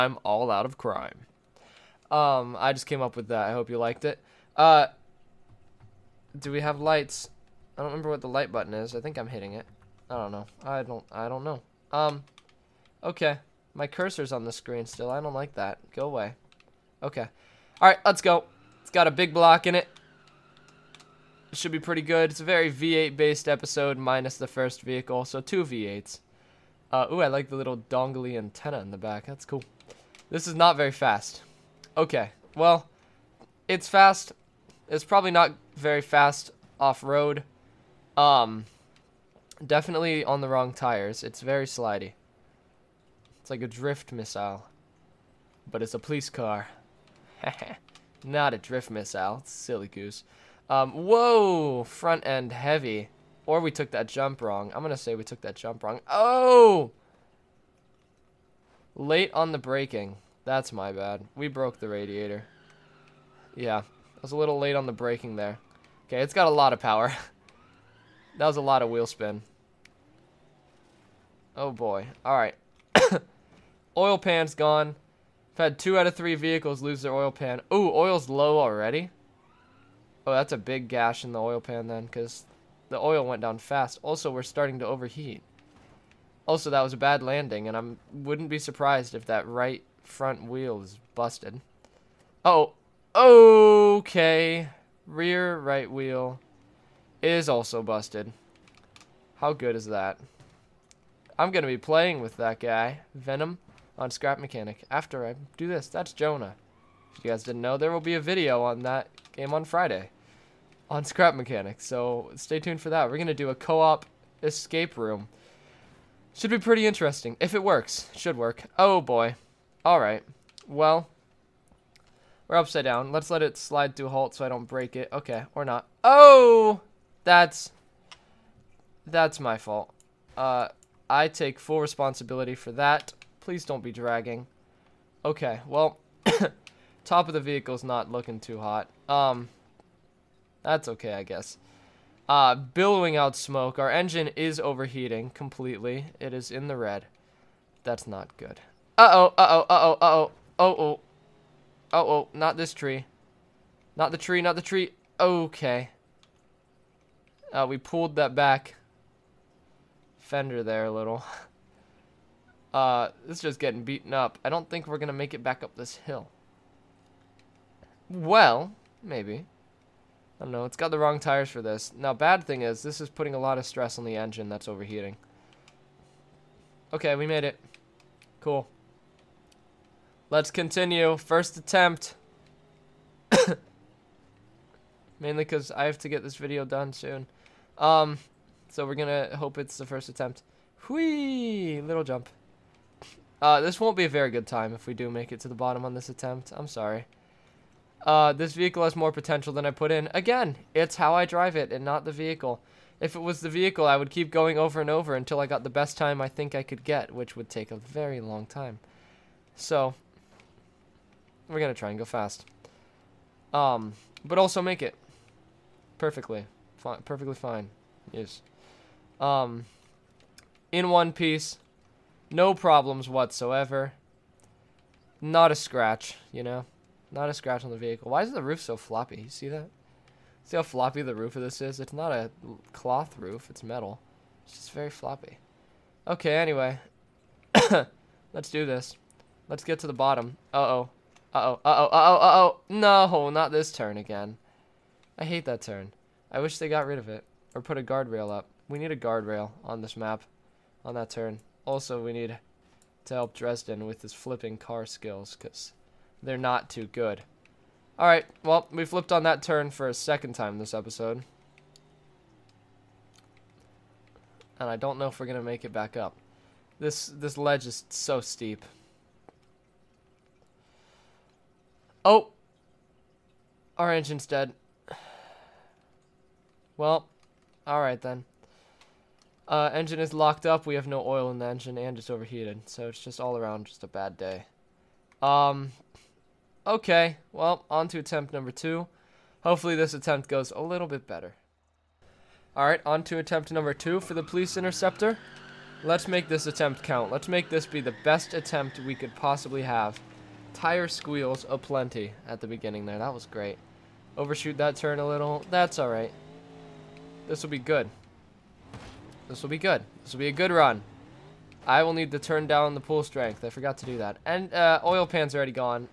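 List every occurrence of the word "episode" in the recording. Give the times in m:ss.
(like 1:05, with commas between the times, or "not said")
0:23, 4:20.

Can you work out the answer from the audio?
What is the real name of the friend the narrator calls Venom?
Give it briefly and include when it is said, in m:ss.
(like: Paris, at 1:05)
Jonah, at 1:46.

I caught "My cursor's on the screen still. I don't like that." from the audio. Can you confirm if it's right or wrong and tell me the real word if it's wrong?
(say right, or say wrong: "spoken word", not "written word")
right.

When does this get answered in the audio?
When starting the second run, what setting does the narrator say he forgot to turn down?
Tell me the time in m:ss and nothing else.
5:12.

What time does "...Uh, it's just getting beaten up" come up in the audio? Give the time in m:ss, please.
2:42.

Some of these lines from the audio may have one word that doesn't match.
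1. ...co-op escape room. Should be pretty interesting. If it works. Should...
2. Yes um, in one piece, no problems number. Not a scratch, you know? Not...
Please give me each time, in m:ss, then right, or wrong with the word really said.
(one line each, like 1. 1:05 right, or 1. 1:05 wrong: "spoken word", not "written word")
1. 1:53 right
2. 3:38 wrong: "whatsoever", not "number".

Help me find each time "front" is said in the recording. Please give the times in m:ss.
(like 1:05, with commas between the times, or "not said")
0:51, 1:30.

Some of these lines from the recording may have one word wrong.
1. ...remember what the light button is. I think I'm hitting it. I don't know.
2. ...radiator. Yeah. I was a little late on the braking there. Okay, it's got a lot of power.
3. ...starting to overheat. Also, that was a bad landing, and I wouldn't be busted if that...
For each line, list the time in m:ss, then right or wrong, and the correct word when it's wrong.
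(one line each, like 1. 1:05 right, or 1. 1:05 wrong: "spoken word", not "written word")
1. 0:07 right
2. 1:01 right
3. 1:24 wrong: "surprised", not "busted".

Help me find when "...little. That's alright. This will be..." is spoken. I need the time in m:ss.
5:05.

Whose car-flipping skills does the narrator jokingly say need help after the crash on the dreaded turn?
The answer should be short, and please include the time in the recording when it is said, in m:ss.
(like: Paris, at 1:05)
Dresden, at 4:13.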